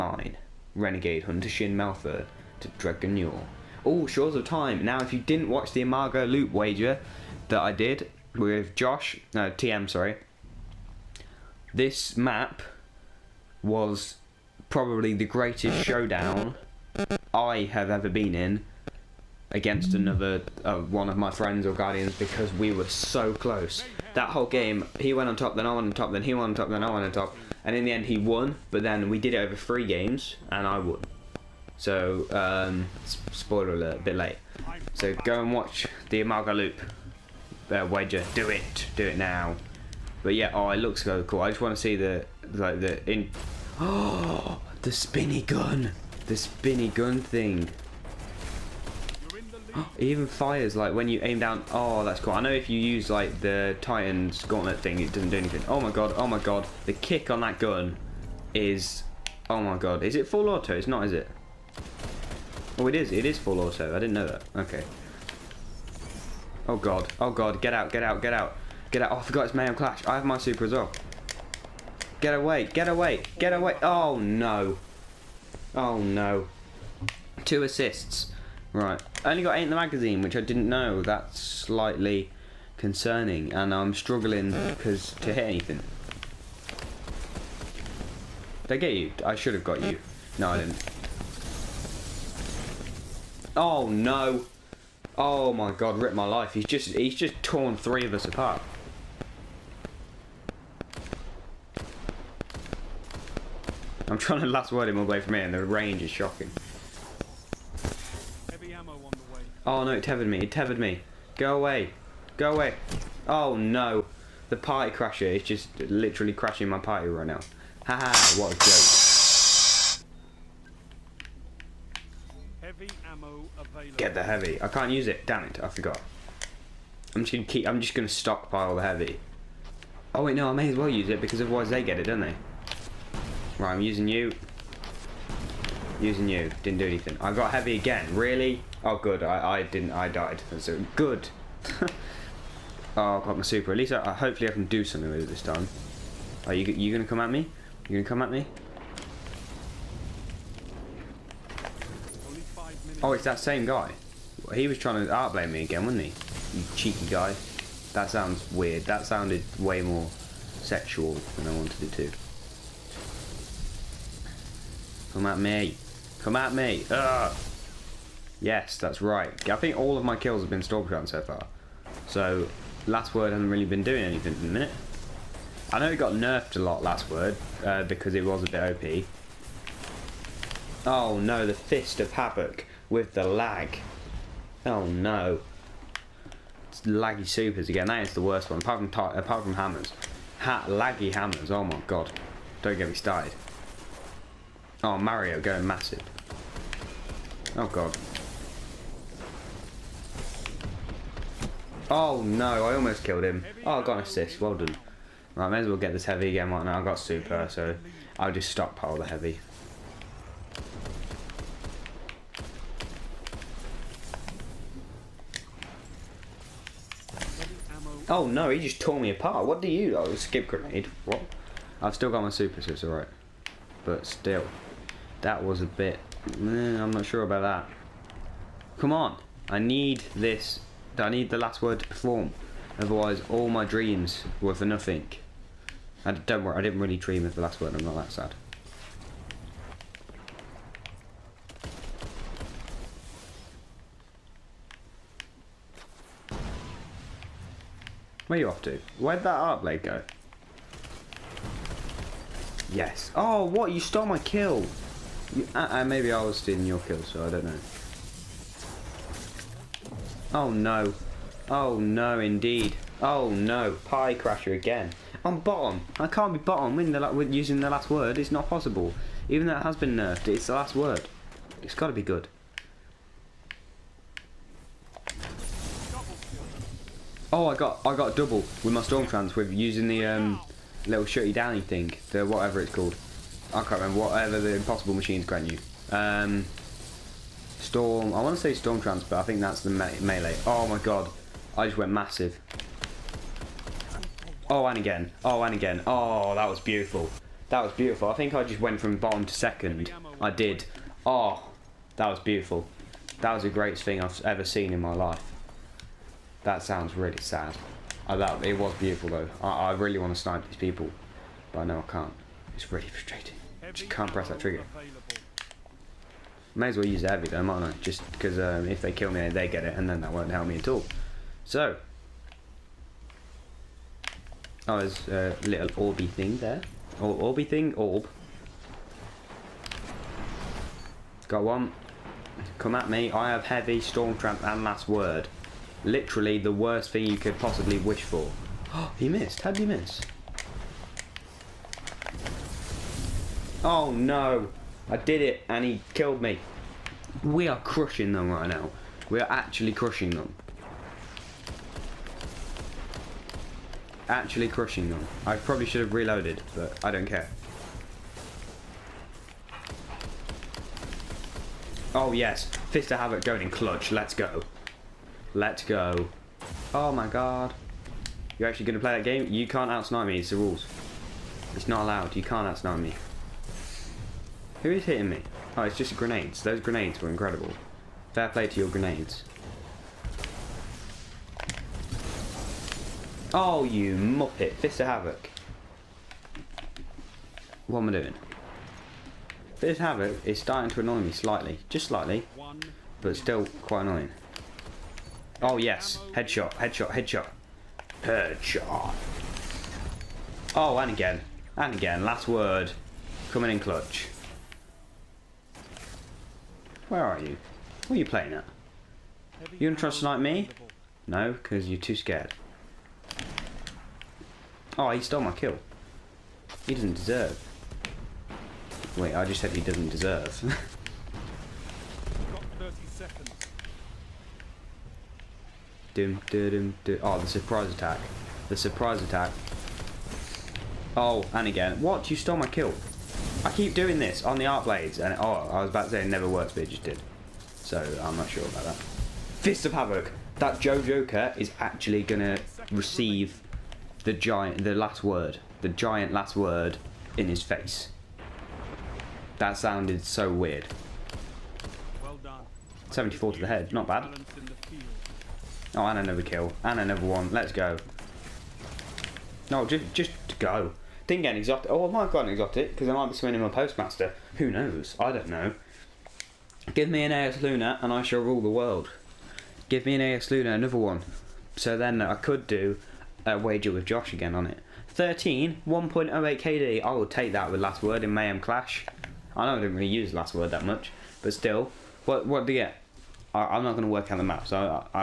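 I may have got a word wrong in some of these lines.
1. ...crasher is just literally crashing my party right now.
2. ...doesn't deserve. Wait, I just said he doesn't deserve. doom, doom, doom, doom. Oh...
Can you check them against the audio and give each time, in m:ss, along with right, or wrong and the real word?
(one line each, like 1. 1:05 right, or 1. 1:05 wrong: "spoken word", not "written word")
1. 1:54 right
2. 6:56 right.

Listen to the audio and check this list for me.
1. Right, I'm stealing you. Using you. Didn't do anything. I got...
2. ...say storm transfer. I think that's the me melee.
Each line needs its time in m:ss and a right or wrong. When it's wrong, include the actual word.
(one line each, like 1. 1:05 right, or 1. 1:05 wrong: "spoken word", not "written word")
1. 2:13 wrong: "using", not "stealing"
2. 4:48 right.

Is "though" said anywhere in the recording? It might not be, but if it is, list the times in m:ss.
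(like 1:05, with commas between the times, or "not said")
4:29, 5:09, 5:17.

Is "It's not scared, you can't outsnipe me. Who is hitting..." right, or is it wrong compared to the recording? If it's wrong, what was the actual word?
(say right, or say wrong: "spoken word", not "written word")
wrong: "allowed", not "scared".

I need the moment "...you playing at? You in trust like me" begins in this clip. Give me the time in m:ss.
6:47.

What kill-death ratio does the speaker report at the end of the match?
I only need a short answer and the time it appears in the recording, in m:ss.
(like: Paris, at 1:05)
1.08, at 7:55.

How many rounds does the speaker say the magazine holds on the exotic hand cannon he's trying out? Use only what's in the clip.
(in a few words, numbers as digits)
8.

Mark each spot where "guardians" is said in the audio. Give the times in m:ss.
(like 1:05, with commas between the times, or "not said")
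0:21.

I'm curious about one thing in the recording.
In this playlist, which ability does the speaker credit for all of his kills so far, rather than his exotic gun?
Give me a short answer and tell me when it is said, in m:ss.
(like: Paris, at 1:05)
Stormshroud, at 2:50.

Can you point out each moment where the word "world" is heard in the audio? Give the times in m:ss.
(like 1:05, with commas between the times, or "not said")
7:48.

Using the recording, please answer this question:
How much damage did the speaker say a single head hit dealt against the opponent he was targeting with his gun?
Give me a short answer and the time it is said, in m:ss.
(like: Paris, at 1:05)
74, at 7:32.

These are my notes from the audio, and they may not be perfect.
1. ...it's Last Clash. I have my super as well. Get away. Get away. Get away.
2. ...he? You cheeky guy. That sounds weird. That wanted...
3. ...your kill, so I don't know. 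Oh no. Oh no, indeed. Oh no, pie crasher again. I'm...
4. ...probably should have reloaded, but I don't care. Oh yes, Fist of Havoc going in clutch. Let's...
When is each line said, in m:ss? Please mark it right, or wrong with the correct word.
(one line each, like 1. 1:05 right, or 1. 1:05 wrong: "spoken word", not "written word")
1. 1:09 wrong: "Mayhem", not "Last"
2. 2:36 wrong: "sounded", not "wanted"
3. 4:16 right
4. 5:55 right.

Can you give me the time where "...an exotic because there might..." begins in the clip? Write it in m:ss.
7:42.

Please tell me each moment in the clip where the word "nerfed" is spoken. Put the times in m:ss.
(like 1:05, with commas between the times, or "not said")
2:56, 4:29.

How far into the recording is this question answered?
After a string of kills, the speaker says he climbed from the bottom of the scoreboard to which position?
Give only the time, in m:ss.
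4:59.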